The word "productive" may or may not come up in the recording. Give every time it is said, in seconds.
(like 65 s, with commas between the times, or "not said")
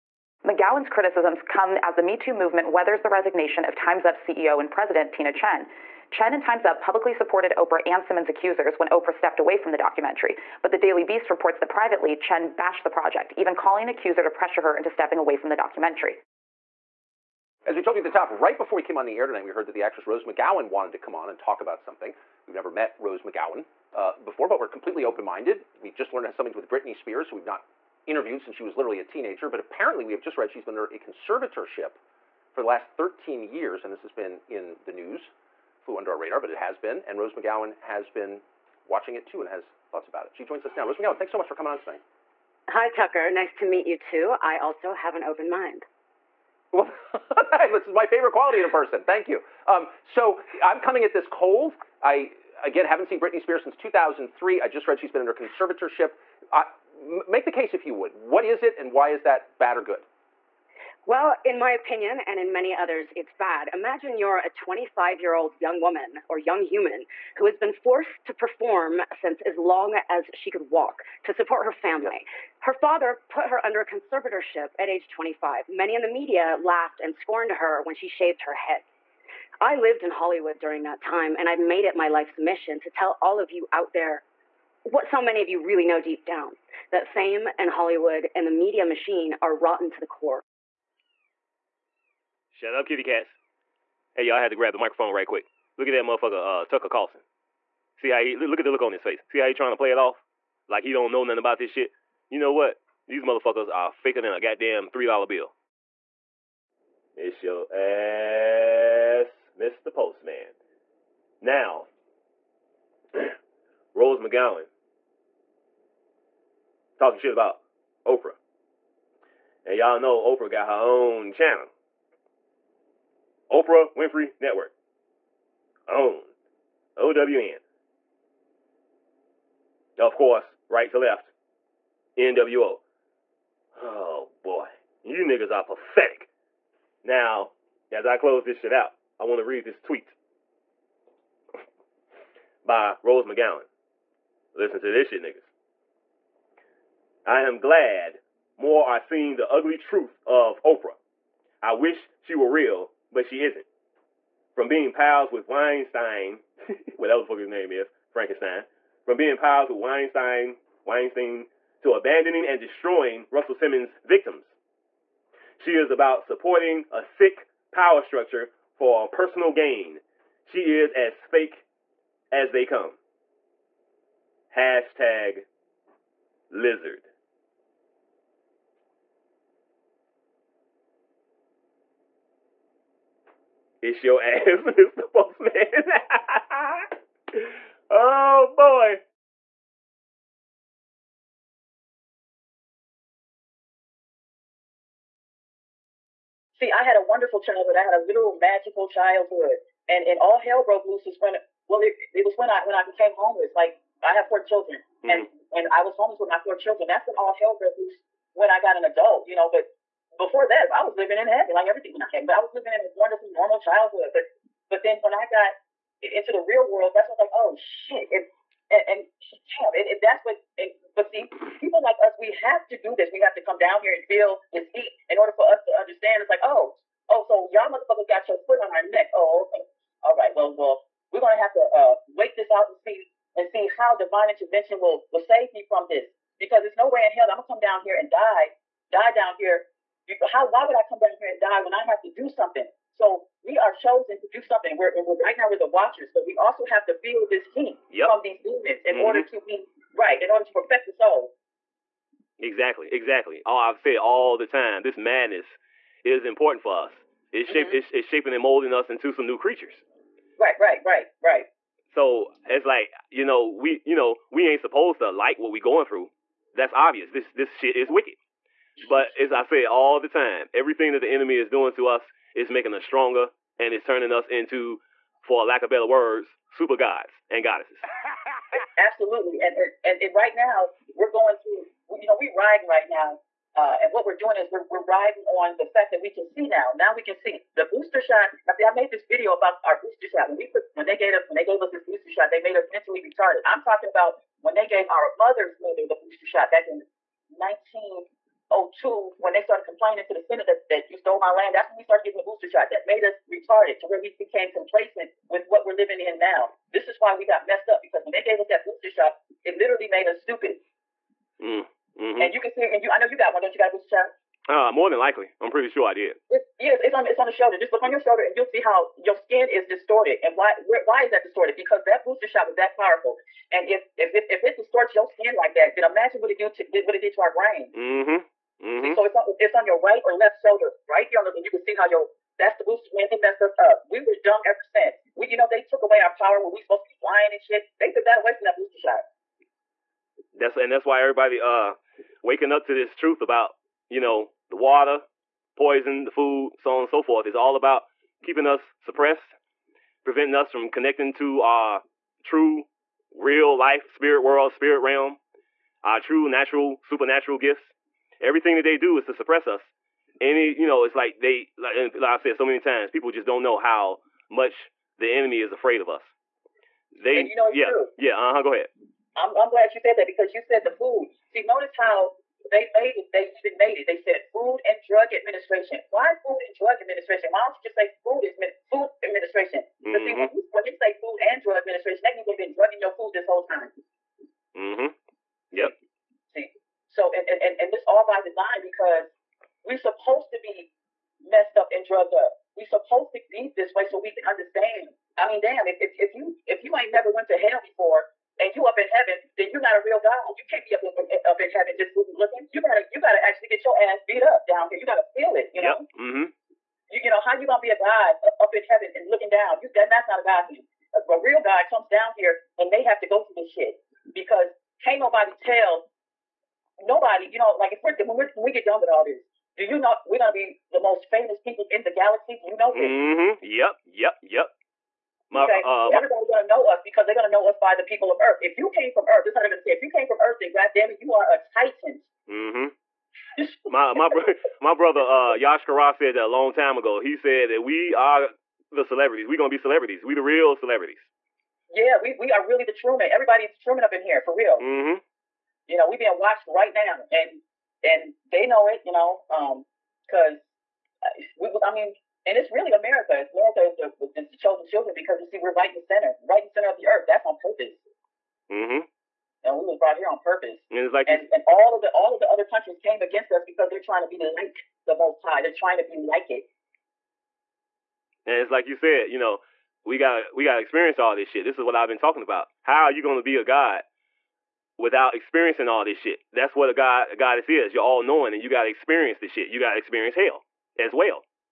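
not said.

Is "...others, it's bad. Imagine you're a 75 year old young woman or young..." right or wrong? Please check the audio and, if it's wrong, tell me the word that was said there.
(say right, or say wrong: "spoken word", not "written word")
wrong: "25", not "75".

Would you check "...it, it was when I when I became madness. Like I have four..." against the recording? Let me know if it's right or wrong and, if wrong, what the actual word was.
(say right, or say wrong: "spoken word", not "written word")
wrong: "homeless", not "madness".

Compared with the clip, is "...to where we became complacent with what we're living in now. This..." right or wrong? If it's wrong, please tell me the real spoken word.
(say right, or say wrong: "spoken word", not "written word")
right.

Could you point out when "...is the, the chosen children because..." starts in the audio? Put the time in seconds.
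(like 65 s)
453 s.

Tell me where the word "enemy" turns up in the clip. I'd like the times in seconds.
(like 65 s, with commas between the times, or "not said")
271 s, 365 s.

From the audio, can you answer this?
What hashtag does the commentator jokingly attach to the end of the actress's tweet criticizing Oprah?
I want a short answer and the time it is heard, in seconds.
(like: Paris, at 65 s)
lizard, at 176 s.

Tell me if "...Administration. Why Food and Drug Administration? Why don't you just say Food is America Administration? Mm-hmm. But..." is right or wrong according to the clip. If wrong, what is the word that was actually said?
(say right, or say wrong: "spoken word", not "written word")
wrong: "Food", not "America".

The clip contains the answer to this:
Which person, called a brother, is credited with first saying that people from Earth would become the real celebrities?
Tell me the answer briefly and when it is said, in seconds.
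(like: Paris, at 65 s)
Yashkara, at 435 s.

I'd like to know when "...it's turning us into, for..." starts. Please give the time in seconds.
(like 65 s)
273 s.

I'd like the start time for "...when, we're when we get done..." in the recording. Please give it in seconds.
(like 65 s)
417 s.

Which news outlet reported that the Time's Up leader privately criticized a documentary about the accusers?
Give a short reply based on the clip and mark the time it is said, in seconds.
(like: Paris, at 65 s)
Daily Beast, at 10 s.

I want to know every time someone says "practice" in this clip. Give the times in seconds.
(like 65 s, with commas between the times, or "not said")
not said.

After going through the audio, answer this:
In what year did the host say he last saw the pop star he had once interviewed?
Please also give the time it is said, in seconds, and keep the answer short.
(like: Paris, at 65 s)
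2003, at 53 s.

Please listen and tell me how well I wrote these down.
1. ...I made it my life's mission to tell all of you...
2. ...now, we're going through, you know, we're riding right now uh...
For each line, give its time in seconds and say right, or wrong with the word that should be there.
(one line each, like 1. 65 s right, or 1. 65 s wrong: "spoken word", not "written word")
1. 81 s right
2. 280 s right.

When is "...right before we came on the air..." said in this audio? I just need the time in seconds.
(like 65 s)
18 s.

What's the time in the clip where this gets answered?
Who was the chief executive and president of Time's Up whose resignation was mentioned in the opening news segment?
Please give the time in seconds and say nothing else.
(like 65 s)
5 s.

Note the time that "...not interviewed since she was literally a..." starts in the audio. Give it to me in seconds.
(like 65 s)
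27 s.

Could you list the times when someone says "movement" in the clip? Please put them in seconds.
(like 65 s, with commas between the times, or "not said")
2 s.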